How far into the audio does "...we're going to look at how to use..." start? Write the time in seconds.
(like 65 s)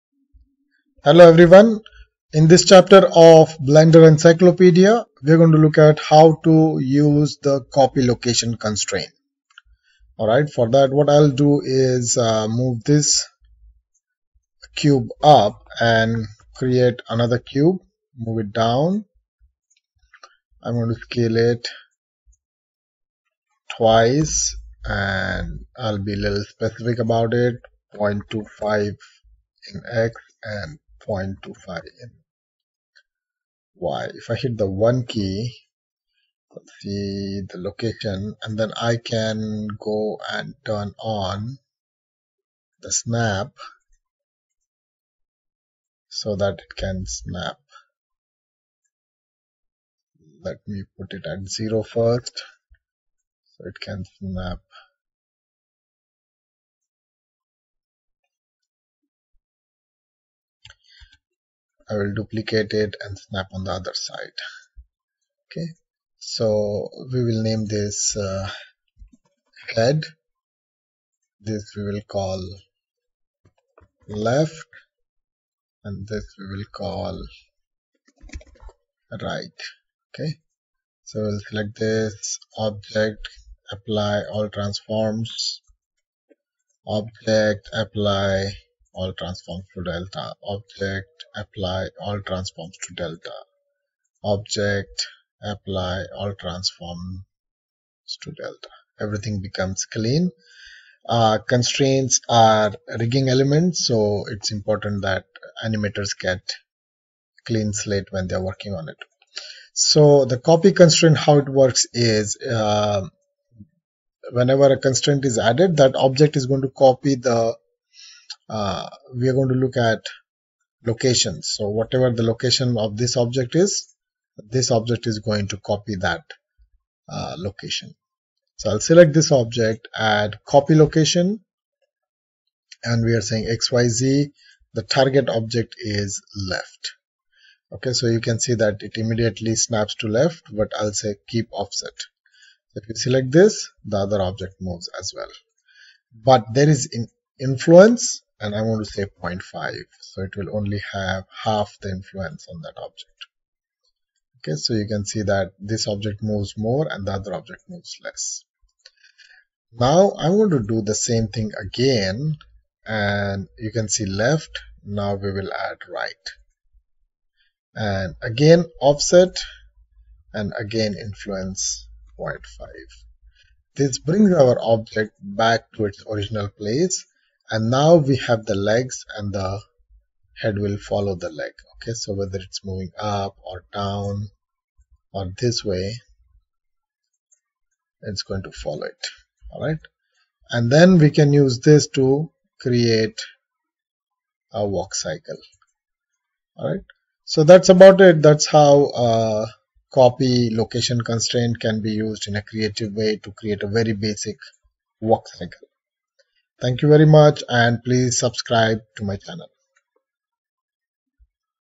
5 s.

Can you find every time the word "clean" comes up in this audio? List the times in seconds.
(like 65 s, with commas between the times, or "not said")
99 s, 107 s.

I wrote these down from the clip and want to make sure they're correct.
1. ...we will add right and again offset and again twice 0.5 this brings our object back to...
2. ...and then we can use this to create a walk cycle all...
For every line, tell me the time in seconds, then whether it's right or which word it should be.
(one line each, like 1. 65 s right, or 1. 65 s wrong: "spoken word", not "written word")
1. 165 s wrong: "influence", not "twice"
2. 190 s right.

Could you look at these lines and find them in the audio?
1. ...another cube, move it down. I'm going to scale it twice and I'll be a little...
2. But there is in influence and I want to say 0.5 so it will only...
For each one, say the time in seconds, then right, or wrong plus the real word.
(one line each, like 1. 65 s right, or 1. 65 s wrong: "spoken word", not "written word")
1. 17 s right
2. 146 s right.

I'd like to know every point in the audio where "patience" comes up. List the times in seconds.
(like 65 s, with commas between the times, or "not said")
not said.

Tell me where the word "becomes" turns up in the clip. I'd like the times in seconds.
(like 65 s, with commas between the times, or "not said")
99 s.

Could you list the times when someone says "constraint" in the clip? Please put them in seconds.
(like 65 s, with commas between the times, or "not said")
8 s, 101 s, 110 s, 114 s, 201 s.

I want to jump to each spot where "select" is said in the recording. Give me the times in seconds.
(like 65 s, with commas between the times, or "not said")
81 s, 128 s, 142 s.